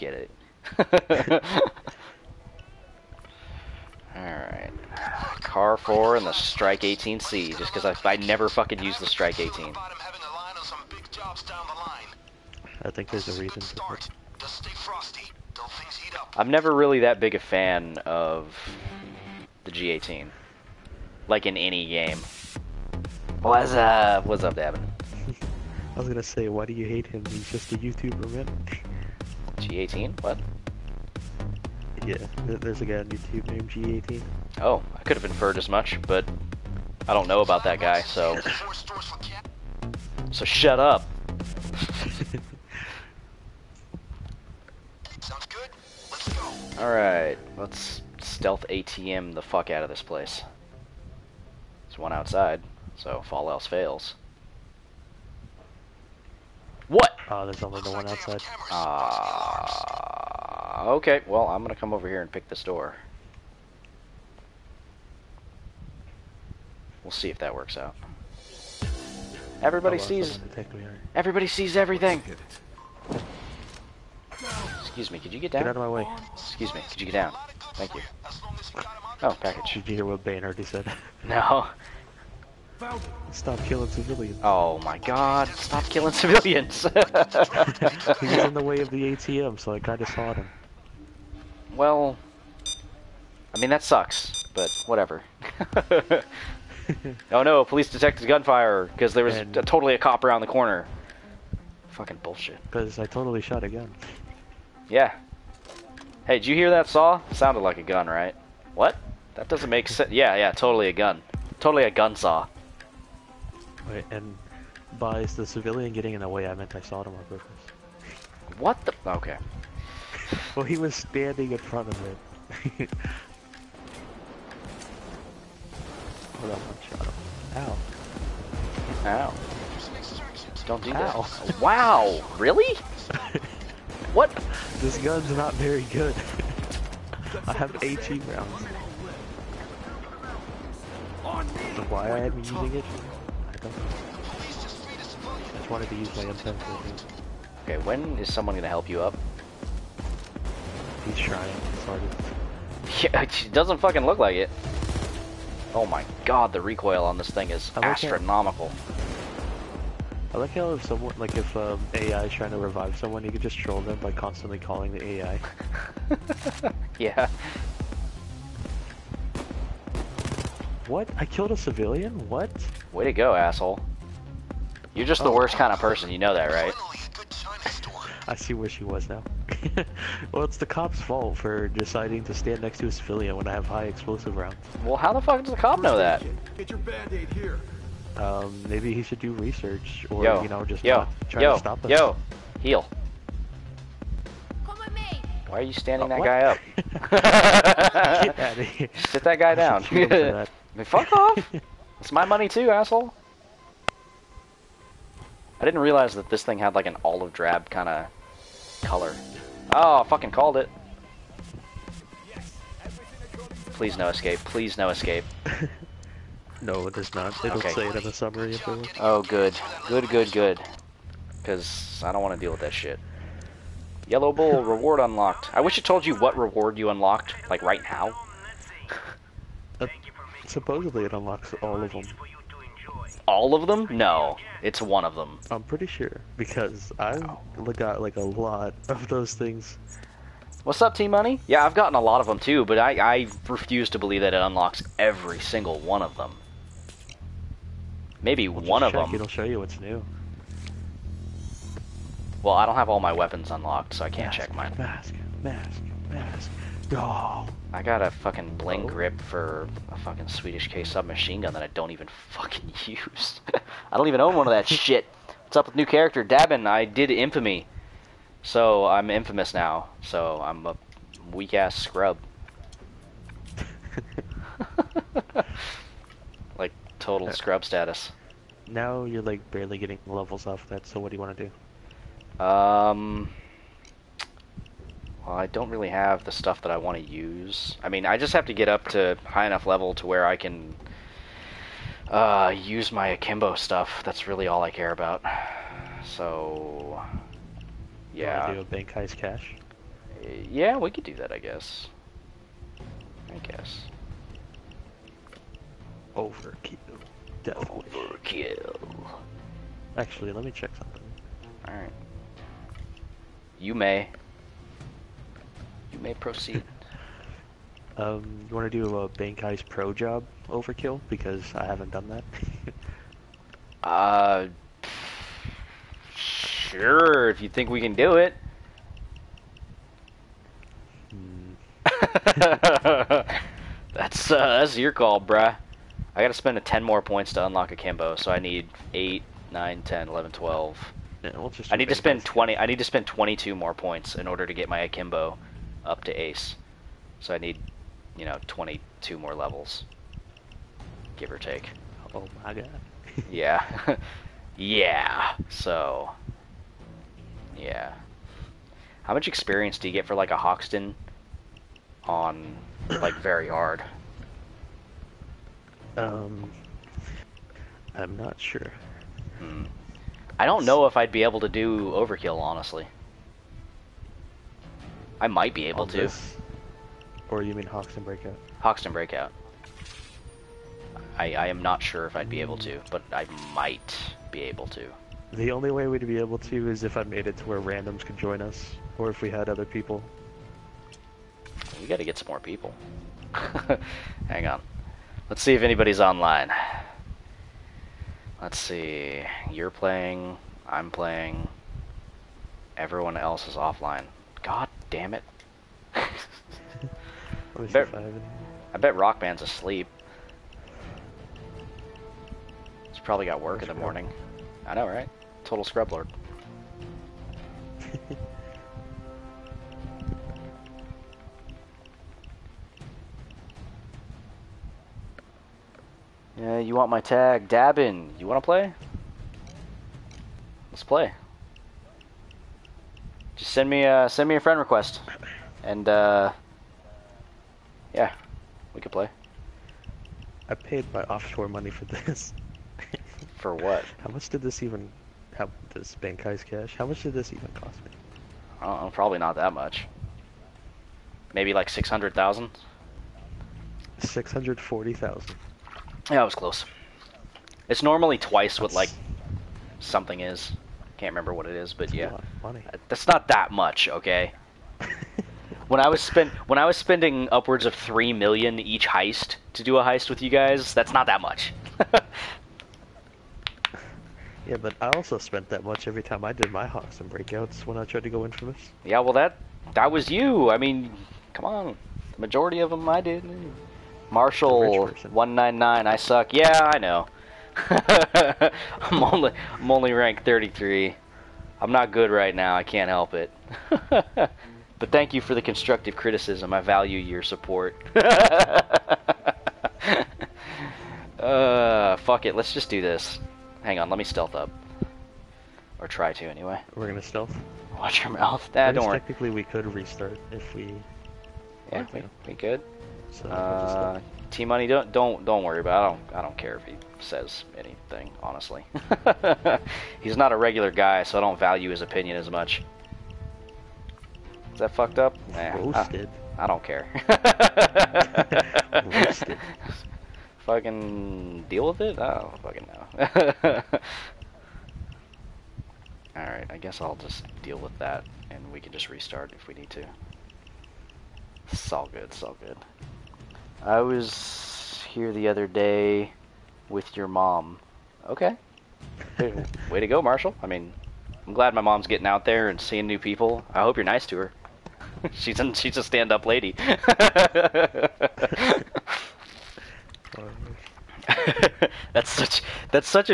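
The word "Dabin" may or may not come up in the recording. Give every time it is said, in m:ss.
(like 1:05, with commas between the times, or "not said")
4:26, 7:07.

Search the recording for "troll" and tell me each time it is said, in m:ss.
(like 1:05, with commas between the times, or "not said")
2:43.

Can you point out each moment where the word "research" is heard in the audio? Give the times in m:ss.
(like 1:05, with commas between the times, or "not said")
3:09.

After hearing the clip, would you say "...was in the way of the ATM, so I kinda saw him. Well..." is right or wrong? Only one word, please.
right.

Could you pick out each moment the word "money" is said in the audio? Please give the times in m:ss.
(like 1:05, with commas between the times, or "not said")
3:22, 4:01, 7:21, 8:34.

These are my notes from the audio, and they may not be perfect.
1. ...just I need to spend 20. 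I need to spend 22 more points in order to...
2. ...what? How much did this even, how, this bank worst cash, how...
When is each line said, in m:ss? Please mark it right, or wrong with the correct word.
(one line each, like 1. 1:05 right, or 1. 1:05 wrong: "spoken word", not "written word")
1. 5:41 right
2. 7:23 wrong: "heist", not "worst".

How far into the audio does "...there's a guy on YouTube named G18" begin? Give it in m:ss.
0:32.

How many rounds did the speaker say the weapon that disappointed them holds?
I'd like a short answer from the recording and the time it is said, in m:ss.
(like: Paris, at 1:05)
18, at 2:17.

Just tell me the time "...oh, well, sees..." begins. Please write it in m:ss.
1:09.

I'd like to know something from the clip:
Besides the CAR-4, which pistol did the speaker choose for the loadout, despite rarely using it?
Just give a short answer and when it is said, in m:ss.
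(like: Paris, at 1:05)
STRYK 18c, at 0:06.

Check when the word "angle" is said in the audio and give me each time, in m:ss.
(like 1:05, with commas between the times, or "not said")
not said.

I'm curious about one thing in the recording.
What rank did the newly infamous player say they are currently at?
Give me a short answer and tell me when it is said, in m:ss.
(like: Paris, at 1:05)
33, at 8:10.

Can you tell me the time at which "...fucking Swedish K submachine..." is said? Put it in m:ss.
4:19.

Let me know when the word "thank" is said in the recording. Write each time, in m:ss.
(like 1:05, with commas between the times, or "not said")
1:17, 8:14.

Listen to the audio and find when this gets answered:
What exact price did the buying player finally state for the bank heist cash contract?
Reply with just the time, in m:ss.
7:33.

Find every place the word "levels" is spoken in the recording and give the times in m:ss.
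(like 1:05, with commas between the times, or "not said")
4:40, 4:49, 5:49.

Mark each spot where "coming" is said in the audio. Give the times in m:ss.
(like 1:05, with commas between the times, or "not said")
not said.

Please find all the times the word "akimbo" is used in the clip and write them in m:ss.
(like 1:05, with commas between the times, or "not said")
4:53, 5:37, 5:44.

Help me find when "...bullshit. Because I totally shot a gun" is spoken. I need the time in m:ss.
1:42.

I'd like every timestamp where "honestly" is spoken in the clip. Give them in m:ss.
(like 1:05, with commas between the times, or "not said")
6:12, 8:38.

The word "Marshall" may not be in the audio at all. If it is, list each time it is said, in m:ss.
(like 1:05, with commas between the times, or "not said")
8:04, 9:10.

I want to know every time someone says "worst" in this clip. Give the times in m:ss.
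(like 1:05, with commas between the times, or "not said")
2:55.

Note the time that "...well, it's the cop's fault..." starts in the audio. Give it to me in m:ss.
3:00.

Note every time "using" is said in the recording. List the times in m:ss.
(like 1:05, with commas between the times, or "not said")
2:22.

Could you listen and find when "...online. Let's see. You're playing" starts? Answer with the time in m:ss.
6:36.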